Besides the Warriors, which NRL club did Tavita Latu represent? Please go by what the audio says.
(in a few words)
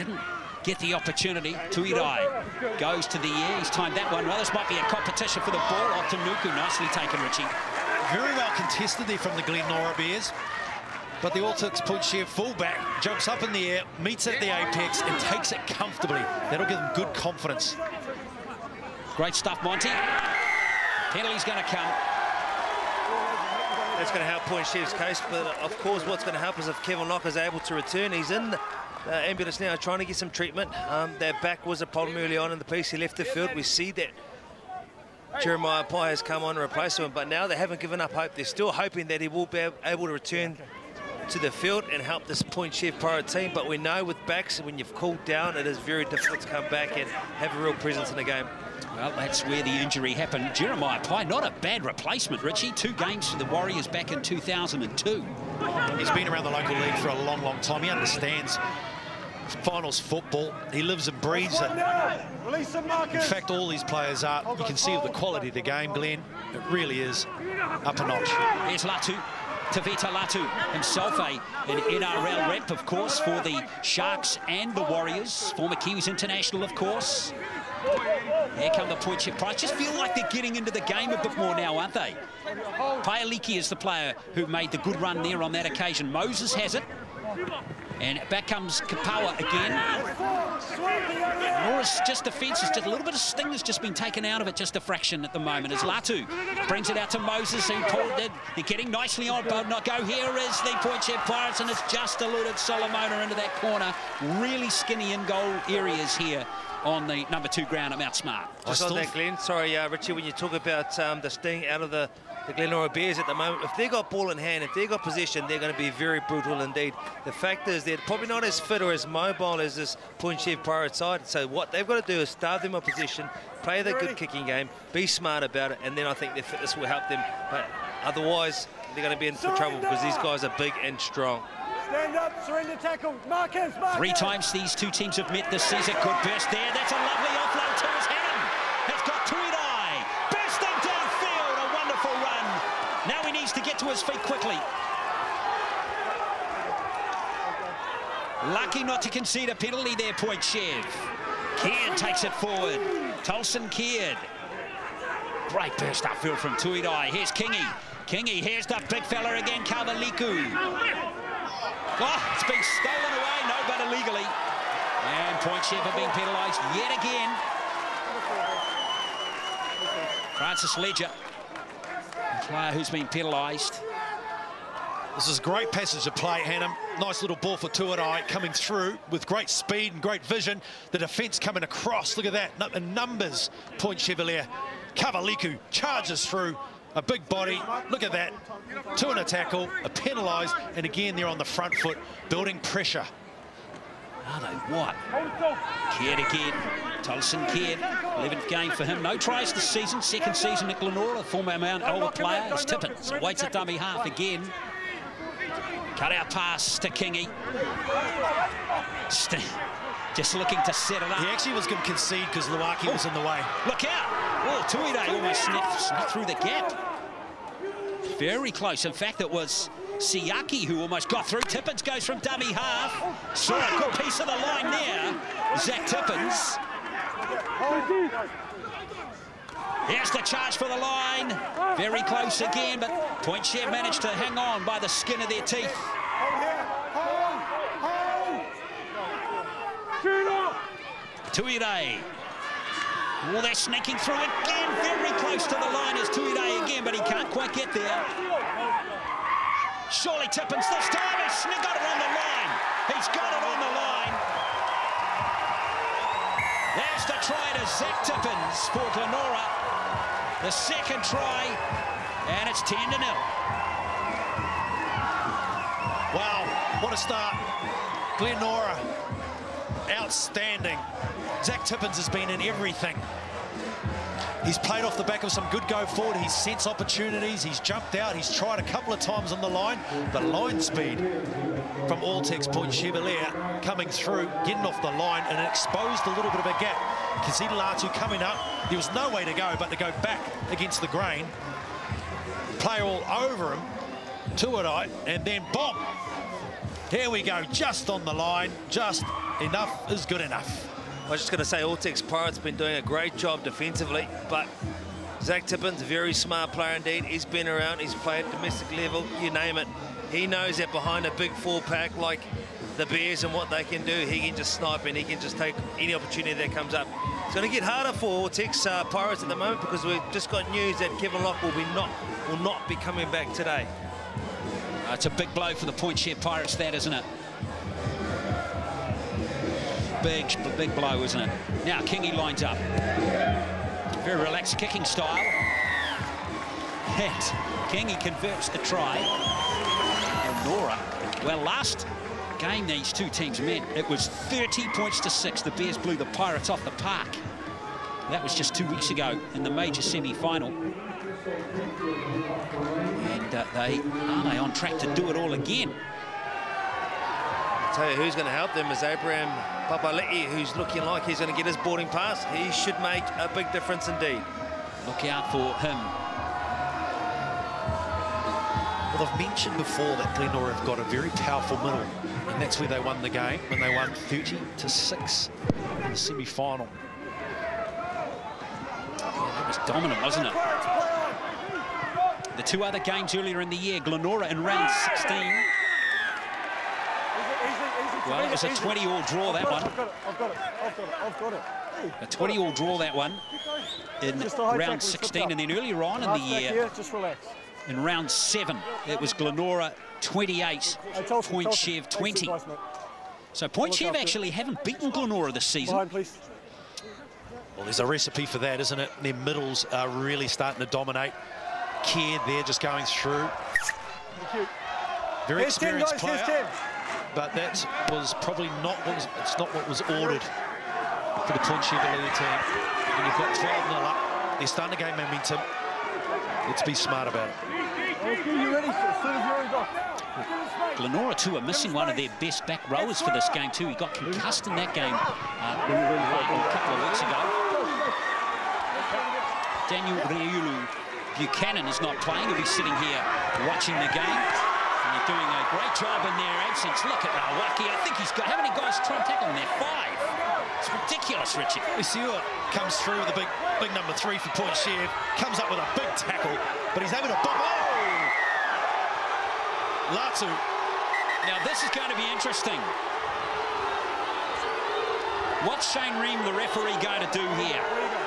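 Sharks.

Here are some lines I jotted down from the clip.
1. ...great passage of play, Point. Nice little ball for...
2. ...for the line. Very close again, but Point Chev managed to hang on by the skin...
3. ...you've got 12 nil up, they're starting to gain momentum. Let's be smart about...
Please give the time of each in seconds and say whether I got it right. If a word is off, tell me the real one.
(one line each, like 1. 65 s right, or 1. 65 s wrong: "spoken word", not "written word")
1. 175 s wrong: "Hannum", not "Point"
2. 230 s right
3. 423 s right.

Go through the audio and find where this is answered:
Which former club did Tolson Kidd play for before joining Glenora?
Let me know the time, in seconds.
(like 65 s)
201 s.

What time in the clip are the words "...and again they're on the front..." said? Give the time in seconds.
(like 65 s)
190 s.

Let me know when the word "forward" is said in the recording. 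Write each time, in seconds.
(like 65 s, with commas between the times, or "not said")
152 s, 275 s.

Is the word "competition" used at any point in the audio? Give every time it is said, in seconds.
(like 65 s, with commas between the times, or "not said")
4 s.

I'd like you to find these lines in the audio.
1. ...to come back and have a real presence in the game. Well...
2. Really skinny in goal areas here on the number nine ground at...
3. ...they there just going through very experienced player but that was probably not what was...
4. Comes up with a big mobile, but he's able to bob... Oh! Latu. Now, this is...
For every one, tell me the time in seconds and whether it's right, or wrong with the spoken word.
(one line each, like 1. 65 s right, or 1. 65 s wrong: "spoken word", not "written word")
1. 46 s right
2. 104 s wrong: "two", not "nine"
3. 411 s right
4. 455 s wrong: "tackle", not "mobile".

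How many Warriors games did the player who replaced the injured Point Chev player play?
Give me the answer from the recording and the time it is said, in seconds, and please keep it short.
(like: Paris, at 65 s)
2, at 52 s.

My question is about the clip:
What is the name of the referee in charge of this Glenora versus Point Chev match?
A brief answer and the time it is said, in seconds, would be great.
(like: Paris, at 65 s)
Shane Ream, at 465 s.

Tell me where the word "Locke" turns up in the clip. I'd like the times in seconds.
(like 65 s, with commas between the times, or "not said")
27 s, 321 s.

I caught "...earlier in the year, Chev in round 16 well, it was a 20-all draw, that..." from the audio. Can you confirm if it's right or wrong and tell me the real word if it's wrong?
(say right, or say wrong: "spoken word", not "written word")
wrong: "Glenora", not "Chev".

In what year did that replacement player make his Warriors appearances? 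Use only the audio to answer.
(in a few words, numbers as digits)
2002.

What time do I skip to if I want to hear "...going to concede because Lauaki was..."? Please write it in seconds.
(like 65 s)
211 s.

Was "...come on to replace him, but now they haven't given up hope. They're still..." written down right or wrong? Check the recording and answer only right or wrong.
right.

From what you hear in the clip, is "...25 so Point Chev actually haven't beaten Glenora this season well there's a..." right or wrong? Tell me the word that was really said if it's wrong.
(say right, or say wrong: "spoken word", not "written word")
wrong: "20", not "25".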